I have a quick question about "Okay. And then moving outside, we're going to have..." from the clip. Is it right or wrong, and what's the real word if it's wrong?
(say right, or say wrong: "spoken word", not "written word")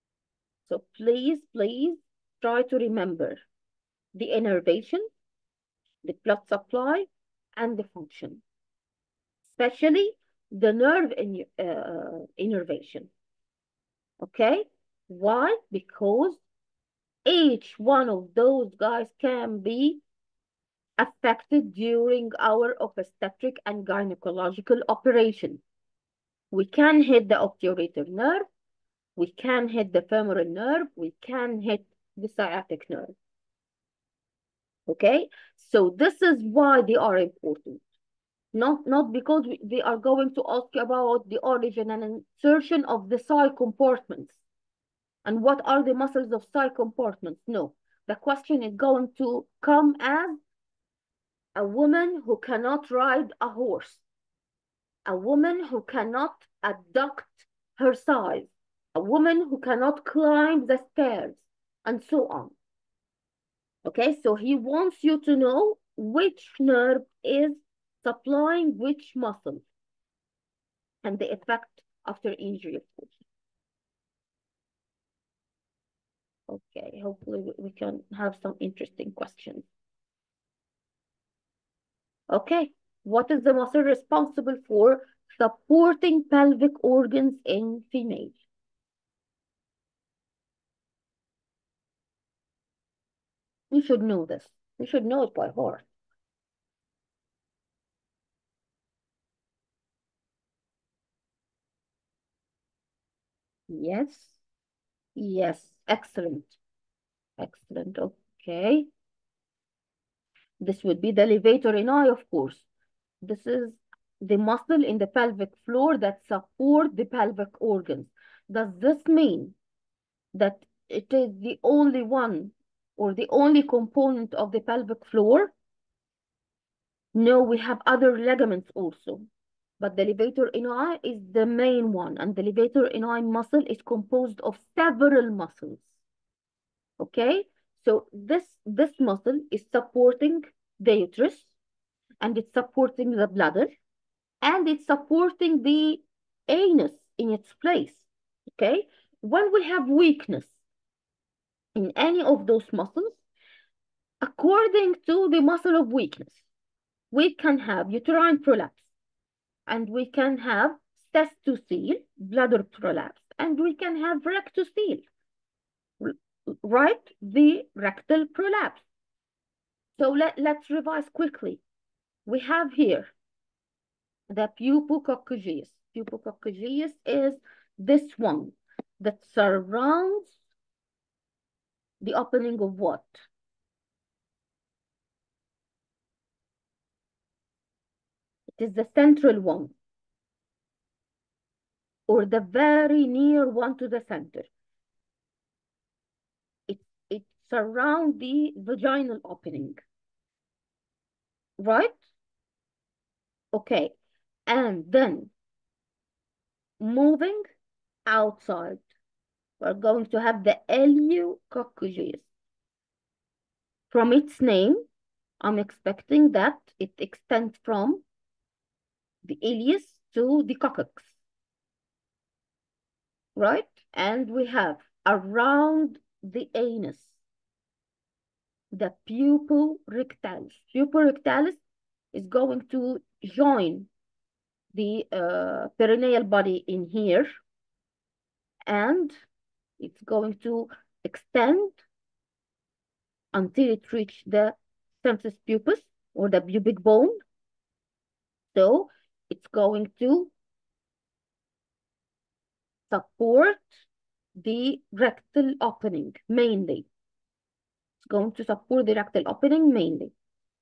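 right.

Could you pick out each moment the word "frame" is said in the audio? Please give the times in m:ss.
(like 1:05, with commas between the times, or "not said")
not said.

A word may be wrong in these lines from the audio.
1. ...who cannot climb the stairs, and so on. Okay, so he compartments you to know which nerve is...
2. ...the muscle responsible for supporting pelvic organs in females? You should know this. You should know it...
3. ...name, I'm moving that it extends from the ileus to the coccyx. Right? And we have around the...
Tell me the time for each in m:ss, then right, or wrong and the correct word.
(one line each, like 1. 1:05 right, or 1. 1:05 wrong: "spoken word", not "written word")
1. 0:59 wrong: "wants", not "compartments"
2. 1:23 right
3. 3:34 wrong: "expecting", not "moving".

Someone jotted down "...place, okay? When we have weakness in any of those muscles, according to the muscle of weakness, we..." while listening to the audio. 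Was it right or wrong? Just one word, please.
right.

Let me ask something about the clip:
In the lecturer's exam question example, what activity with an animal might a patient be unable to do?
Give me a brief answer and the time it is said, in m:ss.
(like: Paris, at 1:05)
Ride a horse, at 0:52.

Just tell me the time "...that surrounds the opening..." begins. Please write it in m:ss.
2:58.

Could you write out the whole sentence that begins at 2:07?
No, we have other ligaments also.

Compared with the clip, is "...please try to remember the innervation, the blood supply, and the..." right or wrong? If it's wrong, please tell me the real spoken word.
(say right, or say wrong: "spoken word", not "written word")
right.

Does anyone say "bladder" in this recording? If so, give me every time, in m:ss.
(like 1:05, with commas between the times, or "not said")
2:23, 2:42.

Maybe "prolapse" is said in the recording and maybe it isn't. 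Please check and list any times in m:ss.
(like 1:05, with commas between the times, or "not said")
2:38, 2:42, 2:48.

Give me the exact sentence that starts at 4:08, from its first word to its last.
So it's going to support the rectal opening mainly going to support the rectal opening mainly.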